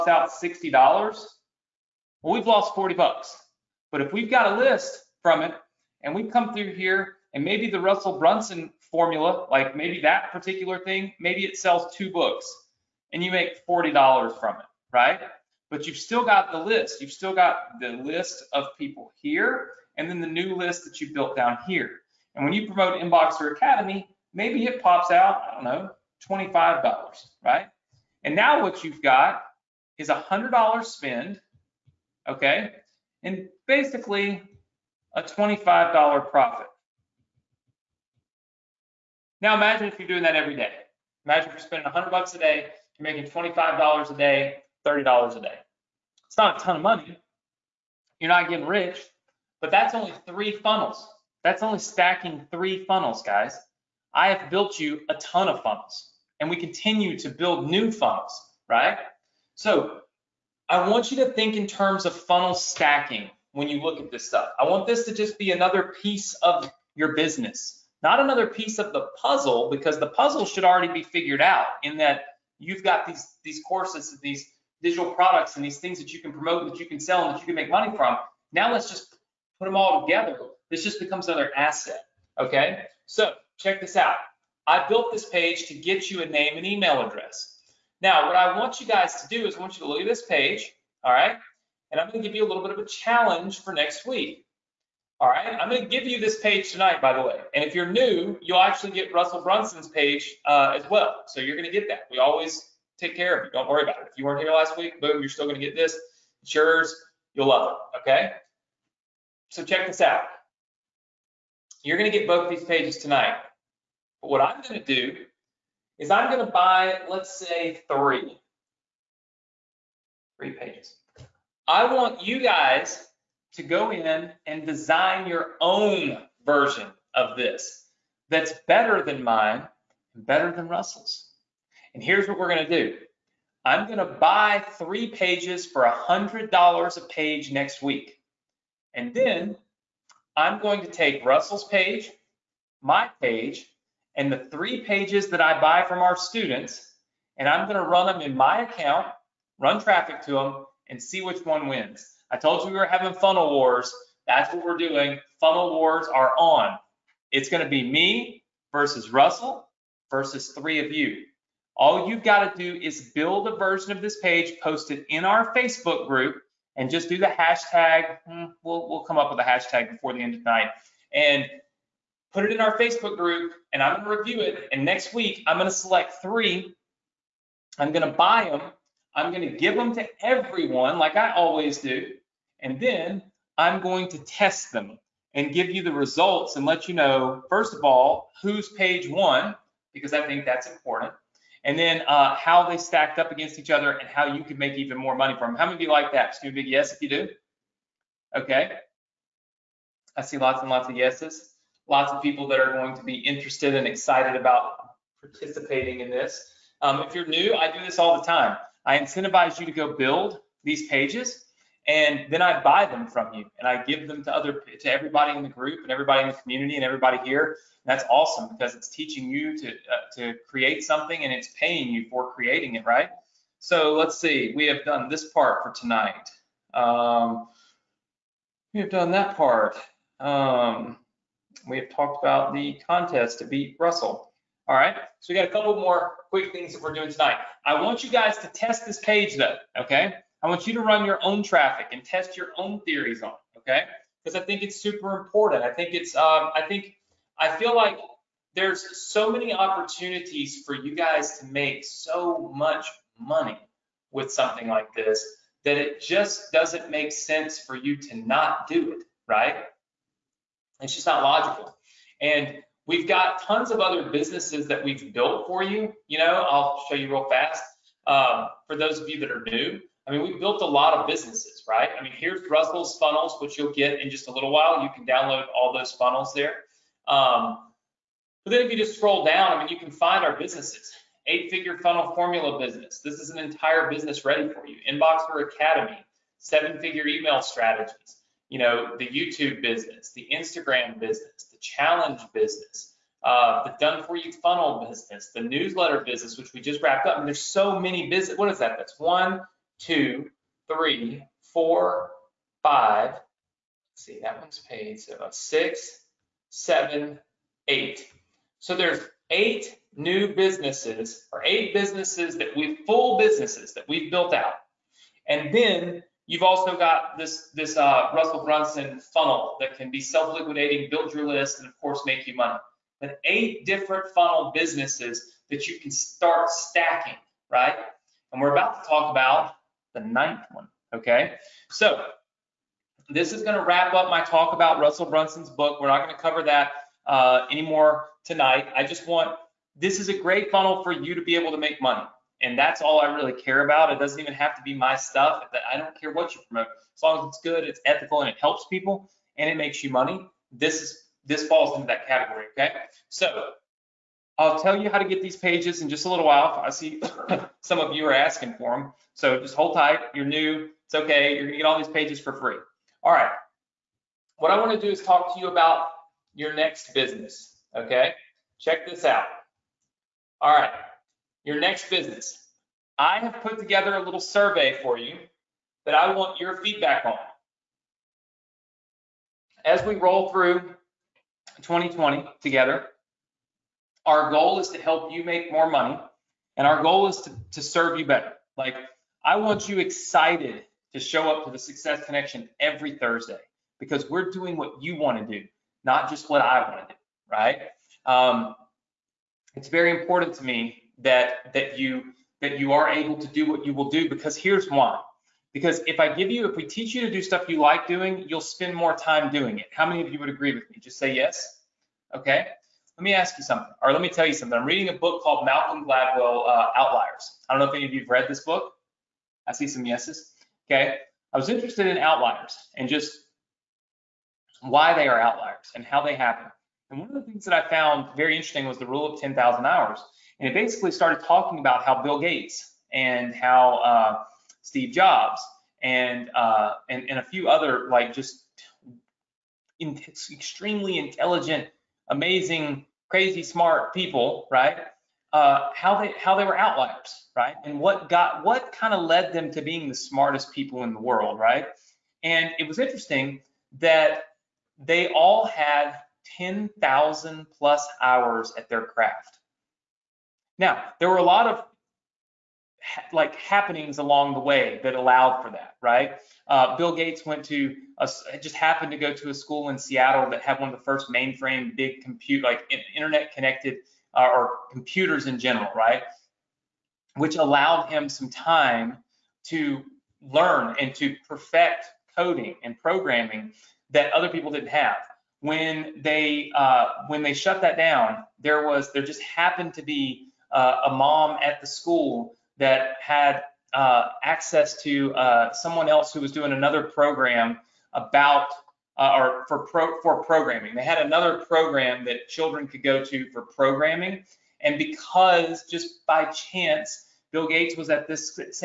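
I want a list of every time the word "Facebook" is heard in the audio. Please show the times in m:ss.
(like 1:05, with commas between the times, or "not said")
2:45, 2:52.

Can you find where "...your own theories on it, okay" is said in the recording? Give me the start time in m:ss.
4:02.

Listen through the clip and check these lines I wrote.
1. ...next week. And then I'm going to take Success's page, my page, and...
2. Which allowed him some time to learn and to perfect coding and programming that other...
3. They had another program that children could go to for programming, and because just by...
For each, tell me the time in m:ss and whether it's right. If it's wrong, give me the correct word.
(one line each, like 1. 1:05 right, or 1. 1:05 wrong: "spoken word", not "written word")
1. 2:17 wrong: "Russell", not "Success"
2. 7:57 right
3. 8:20 right.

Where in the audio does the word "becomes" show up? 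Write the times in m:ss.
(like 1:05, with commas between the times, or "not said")
1:20.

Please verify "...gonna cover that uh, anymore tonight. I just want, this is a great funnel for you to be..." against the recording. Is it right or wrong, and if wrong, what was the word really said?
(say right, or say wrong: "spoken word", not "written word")
right.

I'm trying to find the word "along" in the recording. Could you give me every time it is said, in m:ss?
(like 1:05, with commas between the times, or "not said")
7:43.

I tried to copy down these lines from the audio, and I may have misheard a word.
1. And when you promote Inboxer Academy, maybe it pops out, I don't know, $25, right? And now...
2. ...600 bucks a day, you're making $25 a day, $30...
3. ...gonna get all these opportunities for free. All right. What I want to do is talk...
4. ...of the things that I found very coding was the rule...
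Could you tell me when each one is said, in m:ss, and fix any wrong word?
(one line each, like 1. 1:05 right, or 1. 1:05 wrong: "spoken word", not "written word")
1. 0:22 right
2. 0:41 wrong: "100", not "600"
3. 6:01 wrong: "pages", not "opportunities"
4. 7:07 wrong: "interesting", not "coding".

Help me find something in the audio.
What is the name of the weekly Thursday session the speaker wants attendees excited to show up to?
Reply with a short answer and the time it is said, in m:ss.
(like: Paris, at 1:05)
Success Connection, at 6:31.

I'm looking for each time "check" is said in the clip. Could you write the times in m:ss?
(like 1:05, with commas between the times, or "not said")
1:23, 1:49, 6:08.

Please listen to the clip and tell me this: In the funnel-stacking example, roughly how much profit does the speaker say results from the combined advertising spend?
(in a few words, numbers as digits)
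$25.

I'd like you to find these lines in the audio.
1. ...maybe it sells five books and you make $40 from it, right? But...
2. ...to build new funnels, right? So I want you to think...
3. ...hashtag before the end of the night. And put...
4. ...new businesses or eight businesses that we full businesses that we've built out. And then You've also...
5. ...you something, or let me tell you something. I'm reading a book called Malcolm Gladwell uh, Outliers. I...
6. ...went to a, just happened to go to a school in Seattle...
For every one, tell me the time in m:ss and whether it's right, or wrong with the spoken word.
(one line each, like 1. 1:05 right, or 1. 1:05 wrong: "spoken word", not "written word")
1. 0:11 wrong: "two", not "five"
2. 0:57 right
3. 2:49 right
4. 5:09 right
5. 6:53 right
6. 7:47 right.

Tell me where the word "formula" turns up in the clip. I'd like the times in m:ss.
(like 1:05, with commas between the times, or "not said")
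0:08, 4:42.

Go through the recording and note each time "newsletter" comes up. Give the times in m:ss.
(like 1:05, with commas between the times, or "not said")
4:55.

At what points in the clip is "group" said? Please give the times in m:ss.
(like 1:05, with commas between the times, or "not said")
2:46, 2:53, 3:35.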